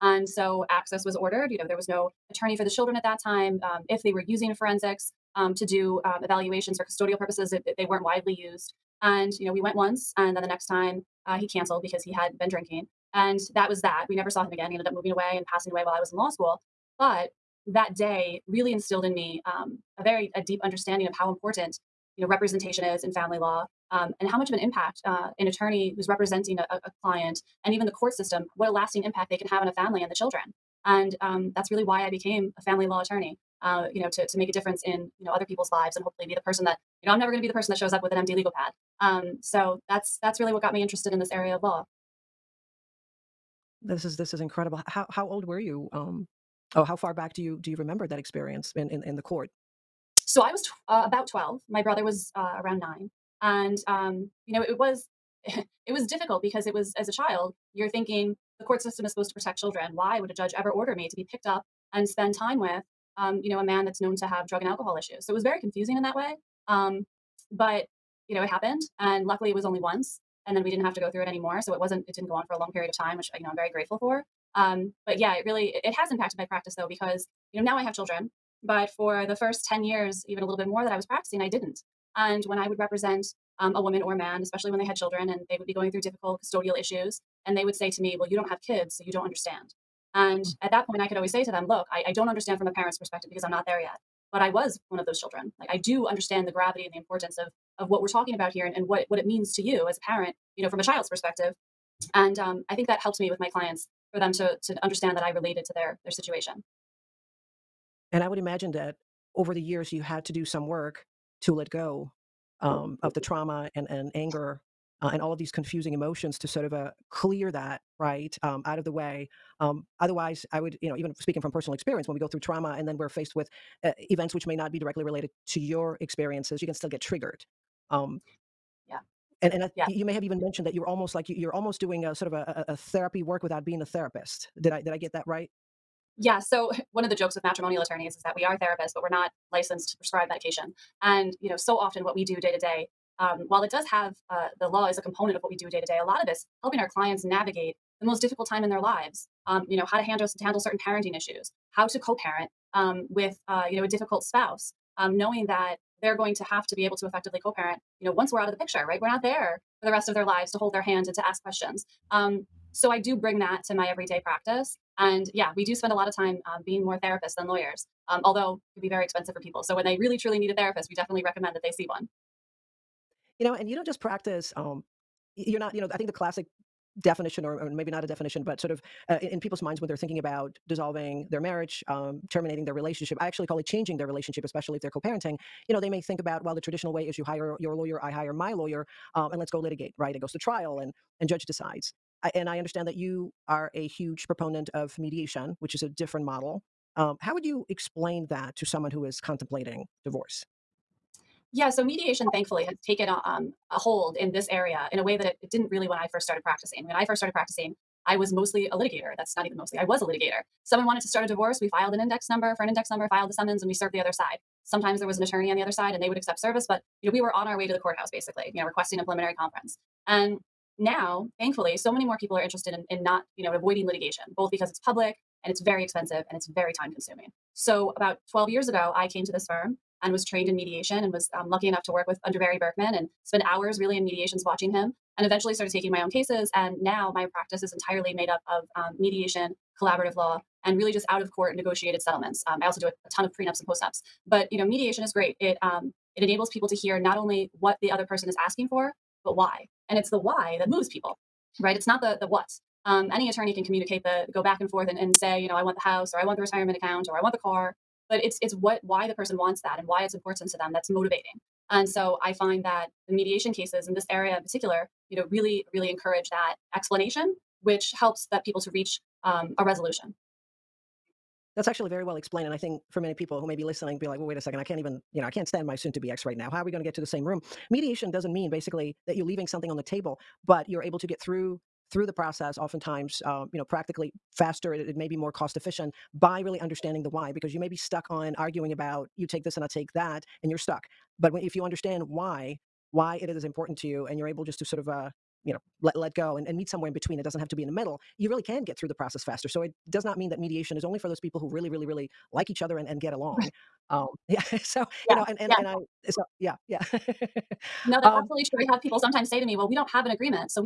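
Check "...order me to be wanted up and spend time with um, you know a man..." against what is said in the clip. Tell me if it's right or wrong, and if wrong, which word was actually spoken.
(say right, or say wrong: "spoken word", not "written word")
wrong: "picked", not "wanted".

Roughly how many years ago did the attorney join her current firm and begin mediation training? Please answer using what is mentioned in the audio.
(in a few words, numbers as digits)
12.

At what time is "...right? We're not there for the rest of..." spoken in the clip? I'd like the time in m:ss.
2:38.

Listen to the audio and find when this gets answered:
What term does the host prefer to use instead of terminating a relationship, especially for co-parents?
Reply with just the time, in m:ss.
3:03.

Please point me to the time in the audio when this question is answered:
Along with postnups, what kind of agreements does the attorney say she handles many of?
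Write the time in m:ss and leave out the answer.
4:03.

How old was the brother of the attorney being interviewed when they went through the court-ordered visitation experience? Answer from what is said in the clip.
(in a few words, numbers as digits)
9.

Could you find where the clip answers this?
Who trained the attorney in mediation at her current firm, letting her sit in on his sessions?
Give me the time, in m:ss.
3:52.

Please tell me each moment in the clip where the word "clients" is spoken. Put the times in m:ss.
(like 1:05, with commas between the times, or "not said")
0:27, 1:43, 2:26.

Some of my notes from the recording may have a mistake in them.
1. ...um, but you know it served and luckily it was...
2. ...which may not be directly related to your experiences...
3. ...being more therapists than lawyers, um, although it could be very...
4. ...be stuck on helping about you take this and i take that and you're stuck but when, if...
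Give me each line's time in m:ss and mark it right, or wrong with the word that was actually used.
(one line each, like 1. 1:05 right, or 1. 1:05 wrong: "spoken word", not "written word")
1. 1:06 wrong: "happened", not "served"
2. 2:04 right
3. 2:46 right
4. 4:47 wrong: "arguing", not "helping".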